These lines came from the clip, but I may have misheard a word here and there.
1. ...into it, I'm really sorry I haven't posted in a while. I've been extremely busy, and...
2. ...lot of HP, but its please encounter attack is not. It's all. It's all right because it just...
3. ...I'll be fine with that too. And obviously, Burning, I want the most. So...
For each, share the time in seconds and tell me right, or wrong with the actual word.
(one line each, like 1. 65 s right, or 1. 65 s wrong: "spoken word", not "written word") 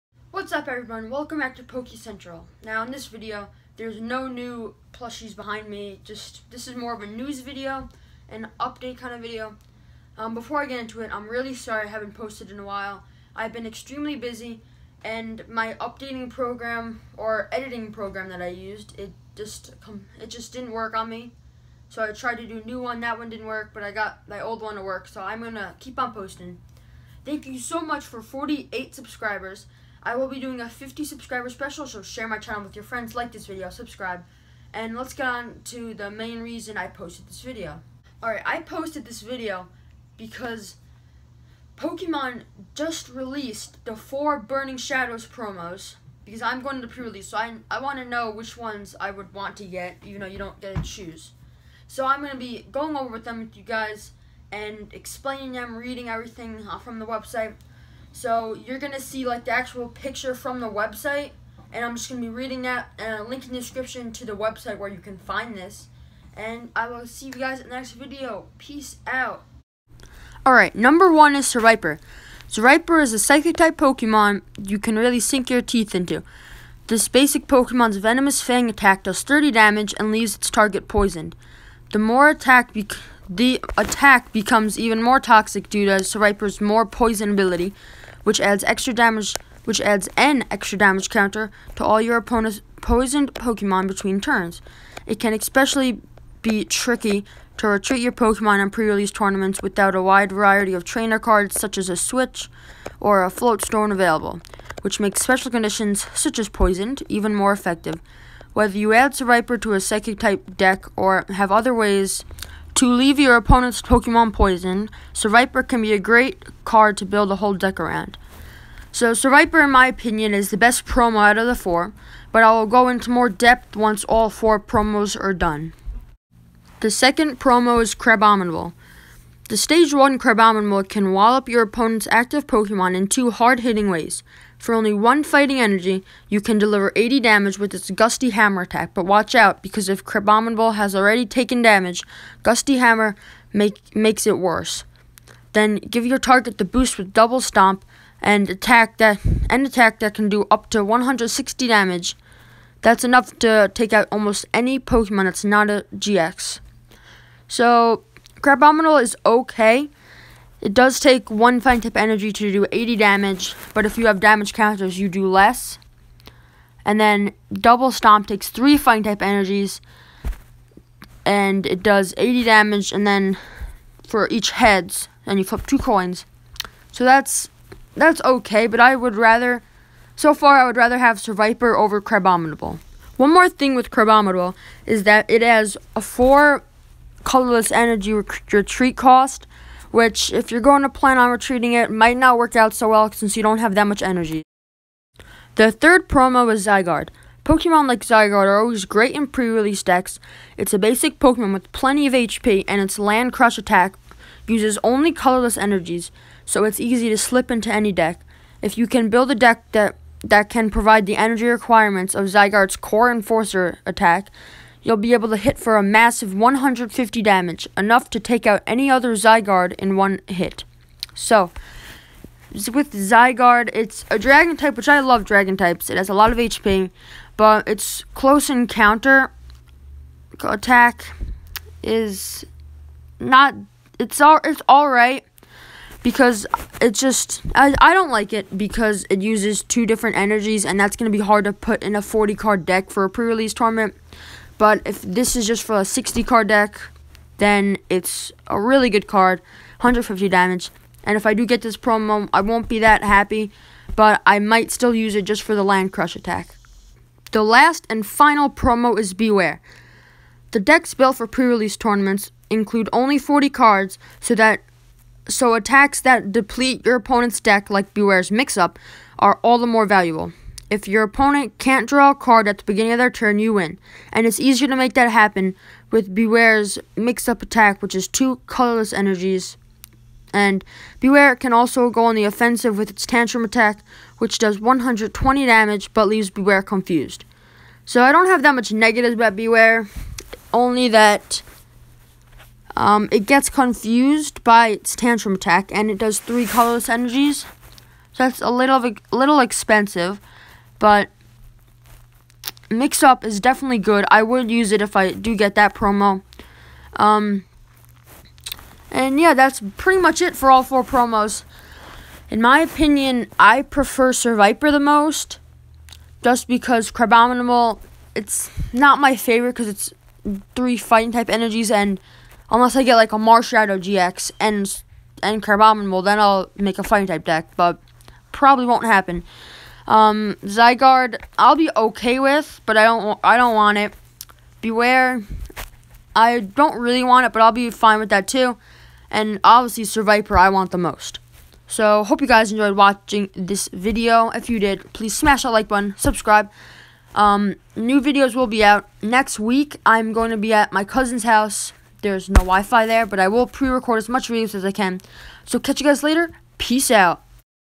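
1. 10 s right
2. 226 s wrong: "close", not "please"
3. 337 s wrong: "Survivor", not "Burning".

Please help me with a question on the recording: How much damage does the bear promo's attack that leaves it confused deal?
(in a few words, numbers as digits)
120.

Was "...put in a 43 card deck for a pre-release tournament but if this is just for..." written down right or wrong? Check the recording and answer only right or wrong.
wrong.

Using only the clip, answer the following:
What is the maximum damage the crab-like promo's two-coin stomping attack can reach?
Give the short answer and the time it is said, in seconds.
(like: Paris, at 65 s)
160, at 150 s.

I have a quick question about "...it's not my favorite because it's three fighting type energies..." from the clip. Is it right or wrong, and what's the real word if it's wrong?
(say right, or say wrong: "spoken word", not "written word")
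right.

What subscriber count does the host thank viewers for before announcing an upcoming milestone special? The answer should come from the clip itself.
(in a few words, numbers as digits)
48.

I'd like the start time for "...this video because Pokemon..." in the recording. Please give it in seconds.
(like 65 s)
39 s.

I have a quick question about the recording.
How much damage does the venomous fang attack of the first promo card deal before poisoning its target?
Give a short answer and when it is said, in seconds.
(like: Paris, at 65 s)
30, at 79 s.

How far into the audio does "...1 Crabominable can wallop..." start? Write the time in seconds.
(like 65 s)
129 s.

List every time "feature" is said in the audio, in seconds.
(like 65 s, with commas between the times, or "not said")
not said.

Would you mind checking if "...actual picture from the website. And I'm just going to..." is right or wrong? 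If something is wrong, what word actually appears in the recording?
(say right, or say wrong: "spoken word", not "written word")
right.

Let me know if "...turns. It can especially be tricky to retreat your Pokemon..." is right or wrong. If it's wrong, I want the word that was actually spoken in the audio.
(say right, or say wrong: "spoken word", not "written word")
right.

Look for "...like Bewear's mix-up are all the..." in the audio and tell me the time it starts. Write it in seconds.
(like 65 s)
267 s.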